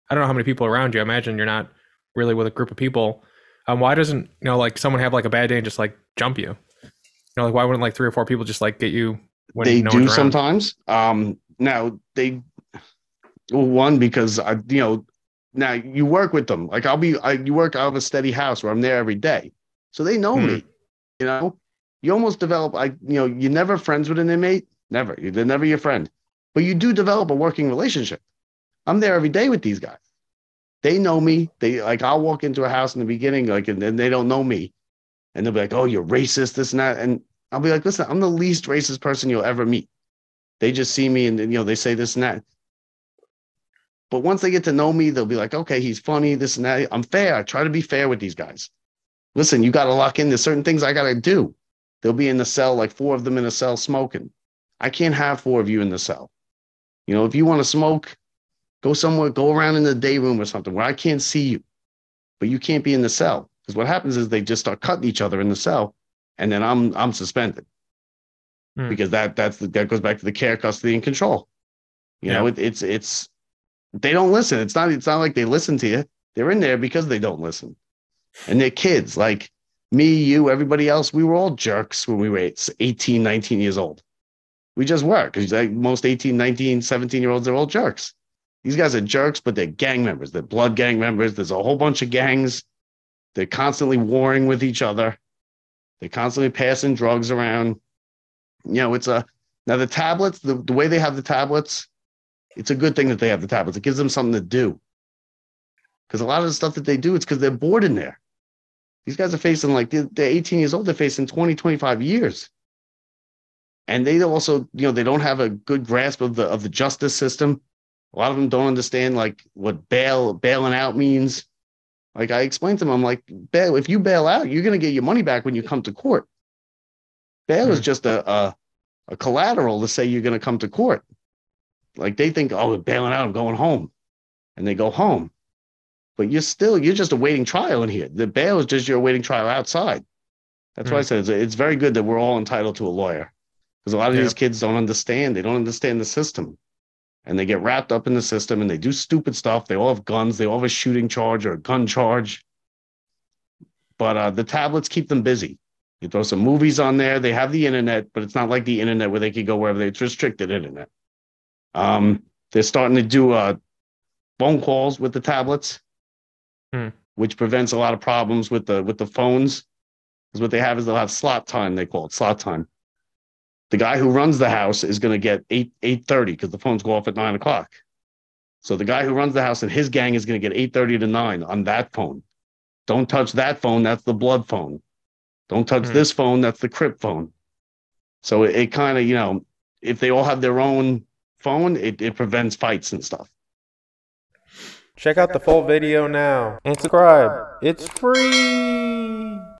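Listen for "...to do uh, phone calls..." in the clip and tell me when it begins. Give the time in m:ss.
2:42.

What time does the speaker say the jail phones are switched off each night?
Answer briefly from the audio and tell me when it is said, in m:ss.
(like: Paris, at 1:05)
9 o'clock, at 2:57.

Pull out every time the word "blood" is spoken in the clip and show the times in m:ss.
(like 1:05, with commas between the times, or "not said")
1:30, 3:04.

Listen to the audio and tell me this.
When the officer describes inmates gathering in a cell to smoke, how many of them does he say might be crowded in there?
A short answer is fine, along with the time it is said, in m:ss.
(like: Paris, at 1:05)
4, at 0:52.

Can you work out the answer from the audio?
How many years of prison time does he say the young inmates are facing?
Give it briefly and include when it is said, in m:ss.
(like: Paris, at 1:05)
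20 to 25 years, at 1:51.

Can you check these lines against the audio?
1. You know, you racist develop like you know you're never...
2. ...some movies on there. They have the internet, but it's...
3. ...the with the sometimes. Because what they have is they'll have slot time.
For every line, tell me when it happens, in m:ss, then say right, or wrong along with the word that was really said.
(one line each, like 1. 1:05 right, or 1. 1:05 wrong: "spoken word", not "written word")
1. 0:21 wrong: "almost", not "racist"
2. 2:36 right
3. 2:48 wrong: "phones", not "sometimes".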